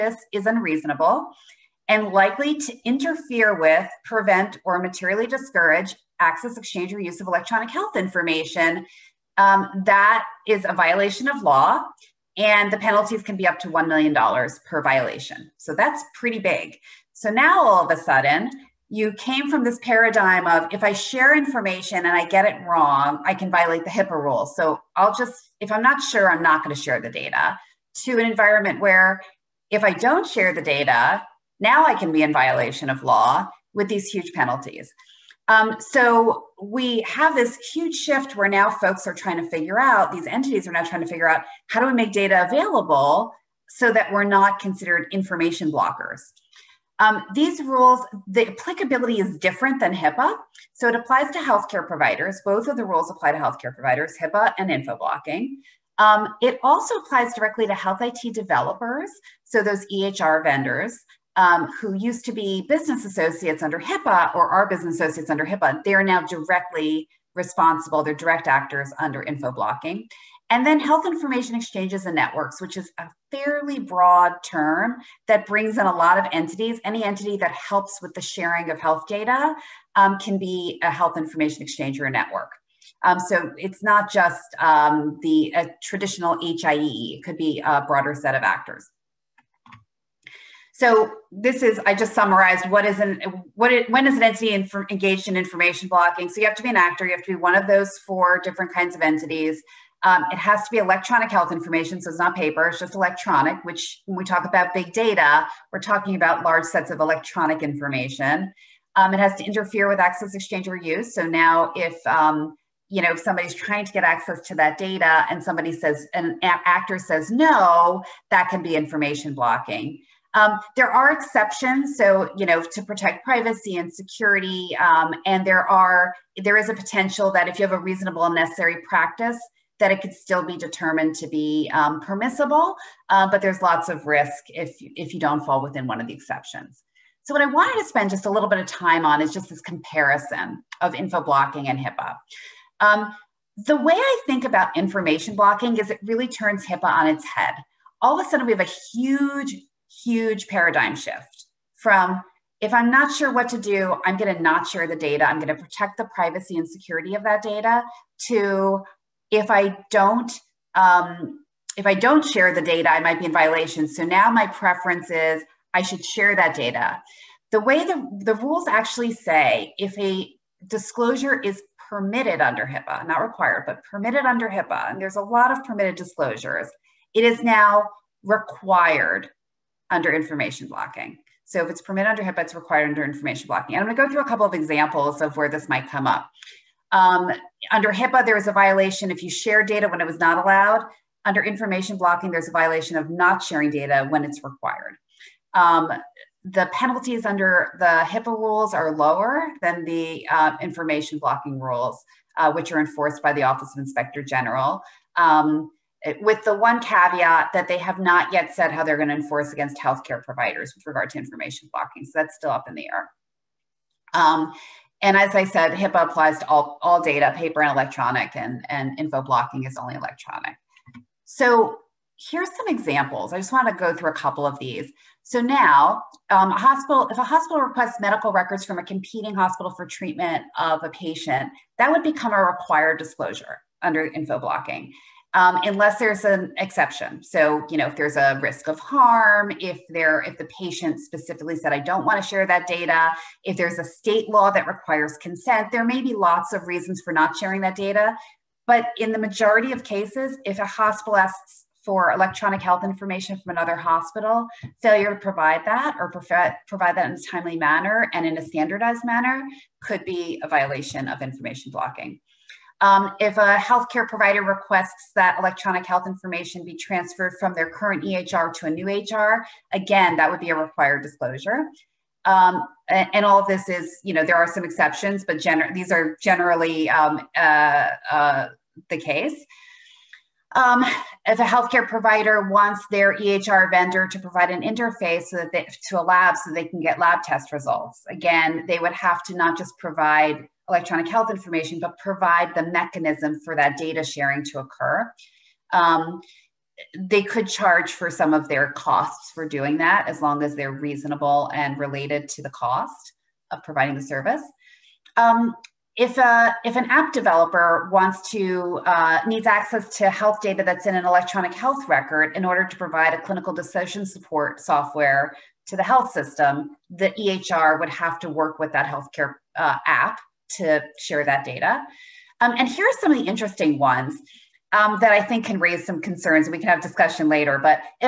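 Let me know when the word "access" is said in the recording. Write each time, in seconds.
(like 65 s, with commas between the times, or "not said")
6 s, 109 s, 114 s, 309 s.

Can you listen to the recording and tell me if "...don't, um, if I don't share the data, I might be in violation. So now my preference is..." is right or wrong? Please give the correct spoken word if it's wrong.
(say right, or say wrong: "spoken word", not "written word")
right.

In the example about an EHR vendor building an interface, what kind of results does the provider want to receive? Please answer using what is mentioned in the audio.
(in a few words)
Lab test results.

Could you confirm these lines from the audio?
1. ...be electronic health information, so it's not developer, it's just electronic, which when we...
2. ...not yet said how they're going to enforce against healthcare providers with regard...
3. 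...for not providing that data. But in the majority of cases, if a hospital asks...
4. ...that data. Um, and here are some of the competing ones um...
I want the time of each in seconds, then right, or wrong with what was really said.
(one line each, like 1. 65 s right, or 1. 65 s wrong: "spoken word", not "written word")
1. 100 s wrong: "paper", not "developer"
2. 207 s right
3. 247 s wrong: "sharing", not "providing"
4. 321 s wrong: "interesting", not "competing".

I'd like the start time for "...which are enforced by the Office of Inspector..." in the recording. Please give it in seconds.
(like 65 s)
202 s.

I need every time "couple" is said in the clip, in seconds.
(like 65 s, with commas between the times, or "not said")
184 s, 224 s.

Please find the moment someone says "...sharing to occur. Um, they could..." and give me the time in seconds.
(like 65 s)
294 s.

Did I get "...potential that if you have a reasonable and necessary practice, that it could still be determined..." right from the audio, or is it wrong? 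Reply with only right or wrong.
right.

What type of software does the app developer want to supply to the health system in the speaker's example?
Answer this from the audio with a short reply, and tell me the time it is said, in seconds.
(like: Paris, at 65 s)
Clinical decision support software, at 313 s.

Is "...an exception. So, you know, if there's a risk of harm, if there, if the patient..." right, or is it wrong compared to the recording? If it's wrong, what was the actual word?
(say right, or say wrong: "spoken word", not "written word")
right.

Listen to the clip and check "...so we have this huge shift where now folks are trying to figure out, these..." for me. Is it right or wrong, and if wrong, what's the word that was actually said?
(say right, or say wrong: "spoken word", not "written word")
right.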